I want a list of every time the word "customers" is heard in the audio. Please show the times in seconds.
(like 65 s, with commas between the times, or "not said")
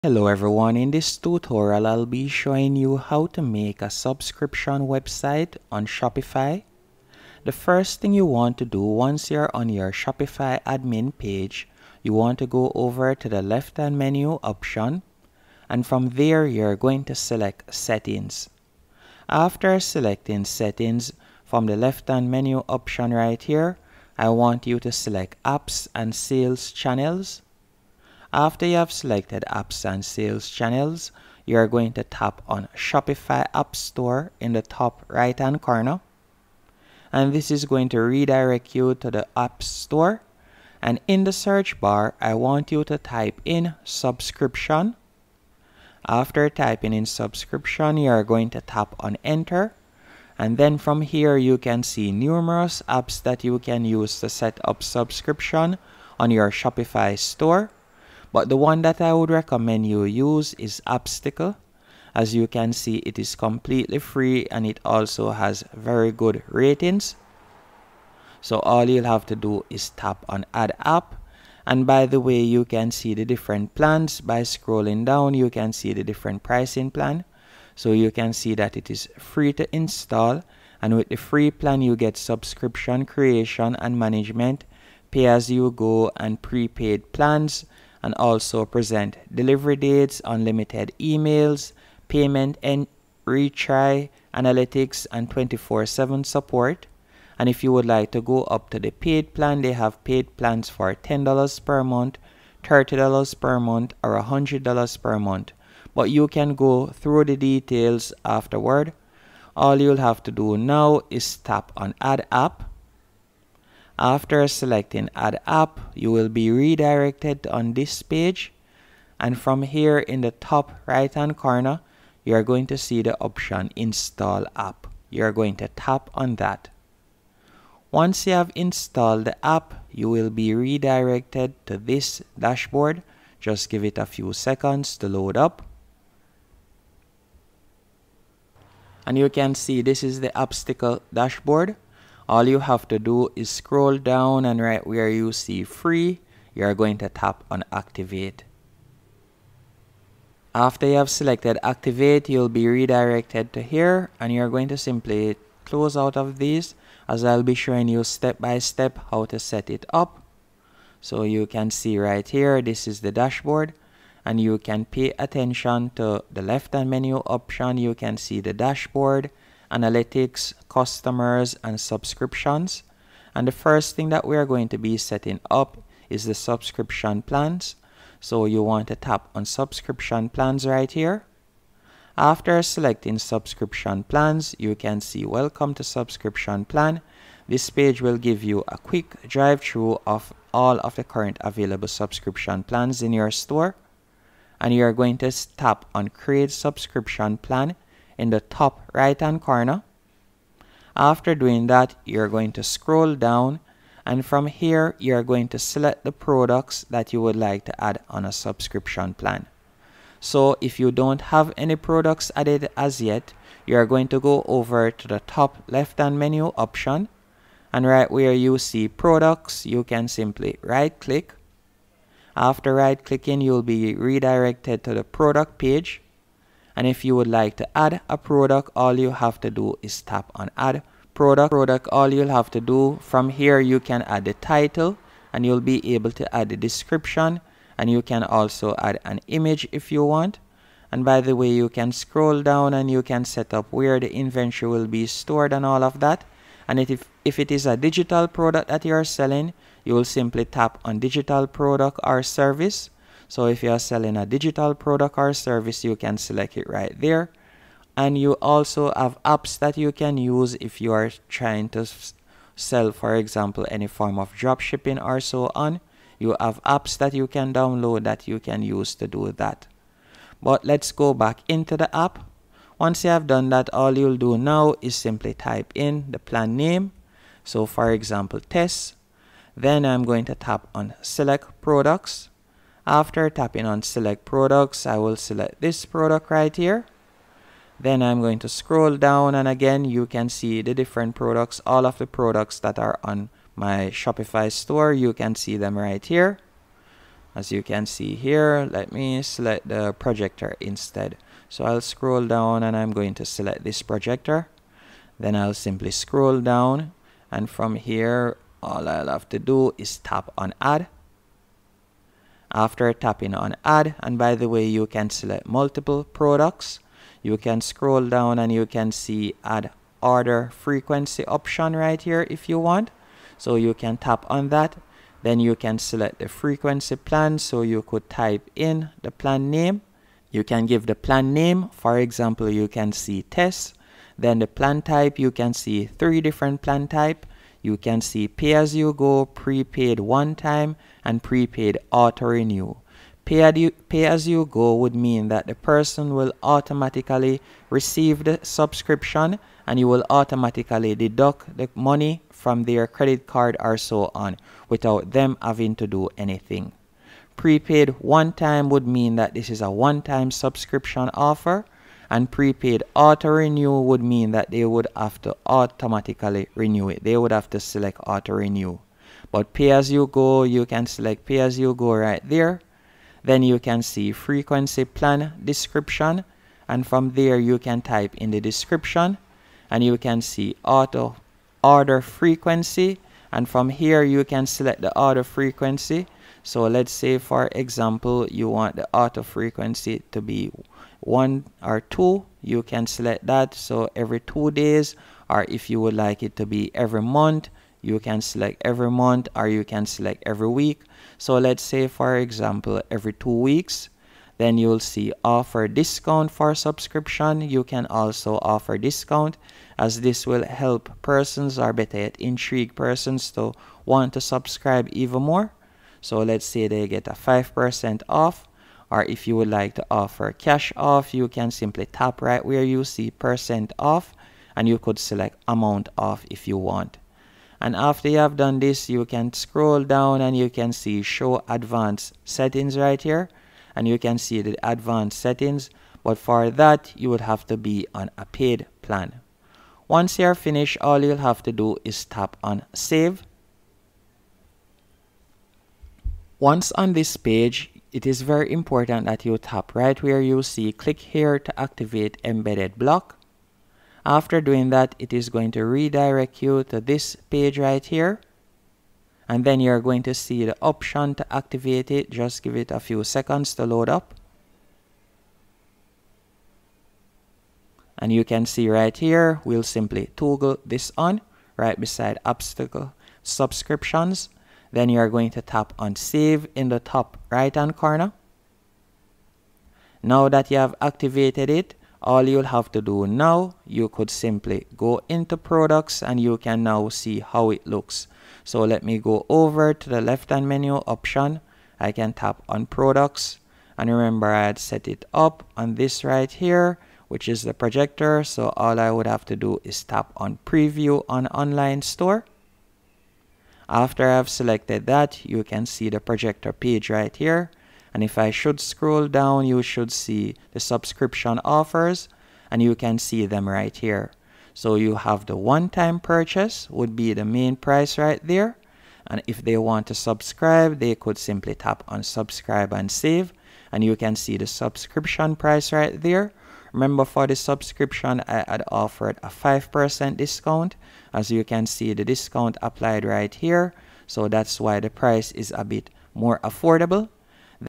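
170 s.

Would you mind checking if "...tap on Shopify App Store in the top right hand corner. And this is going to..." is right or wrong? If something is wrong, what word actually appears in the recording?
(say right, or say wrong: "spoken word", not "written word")
right.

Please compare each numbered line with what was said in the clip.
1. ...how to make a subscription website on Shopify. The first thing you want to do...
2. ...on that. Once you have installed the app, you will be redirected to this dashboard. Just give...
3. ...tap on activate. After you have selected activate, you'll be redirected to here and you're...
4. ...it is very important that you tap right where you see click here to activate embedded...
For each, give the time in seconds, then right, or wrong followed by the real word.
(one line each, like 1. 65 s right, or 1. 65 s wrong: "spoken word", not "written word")
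1. 2 s right
2. 126 s right
3. 147 s right
4. 447 s right.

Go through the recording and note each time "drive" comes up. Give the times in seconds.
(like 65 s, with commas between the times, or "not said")
189 s.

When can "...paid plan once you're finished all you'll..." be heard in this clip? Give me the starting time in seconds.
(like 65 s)
438 s.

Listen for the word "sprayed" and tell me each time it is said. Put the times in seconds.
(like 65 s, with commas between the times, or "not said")
not said.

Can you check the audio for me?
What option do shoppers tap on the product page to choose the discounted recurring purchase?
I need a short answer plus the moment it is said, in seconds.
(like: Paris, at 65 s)
subscribe and save, at 522 s.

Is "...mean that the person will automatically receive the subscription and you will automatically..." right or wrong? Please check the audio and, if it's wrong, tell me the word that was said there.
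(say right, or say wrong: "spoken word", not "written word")
right.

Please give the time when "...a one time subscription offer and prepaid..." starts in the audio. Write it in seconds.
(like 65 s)
359 s.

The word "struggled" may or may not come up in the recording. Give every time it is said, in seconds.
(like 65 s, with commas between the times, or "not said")
not said.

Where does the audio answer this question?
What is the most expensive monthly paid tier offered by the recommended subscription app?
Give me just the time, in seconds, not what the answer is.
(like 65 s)
104 s.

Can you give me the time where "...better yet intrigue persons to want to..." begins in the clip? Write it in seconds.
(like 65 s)
411 s.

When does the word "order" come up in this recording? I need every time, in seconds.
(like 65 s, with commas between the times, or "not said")
320 s, 381 s.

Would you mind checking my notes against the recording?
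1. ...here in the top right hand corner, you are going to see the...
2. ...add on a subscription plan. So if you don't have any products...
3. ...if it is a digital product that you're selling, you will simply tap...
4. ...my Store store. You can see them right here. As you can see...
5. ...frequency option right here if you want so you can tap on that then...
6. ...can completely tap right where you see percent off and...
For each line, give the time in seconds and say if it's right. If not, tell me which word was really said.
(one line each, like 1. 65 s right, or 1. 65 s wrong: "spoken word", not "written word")
1. 119 s right
2. 207 s right
3. 247 s right
4. 293 s wrong: "Shopify", not "Store"
5. 320 s right
6. 421 s wrong: "simply", not "completely".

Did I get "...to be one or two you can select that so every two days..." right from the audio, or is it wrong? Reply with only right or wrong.
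right.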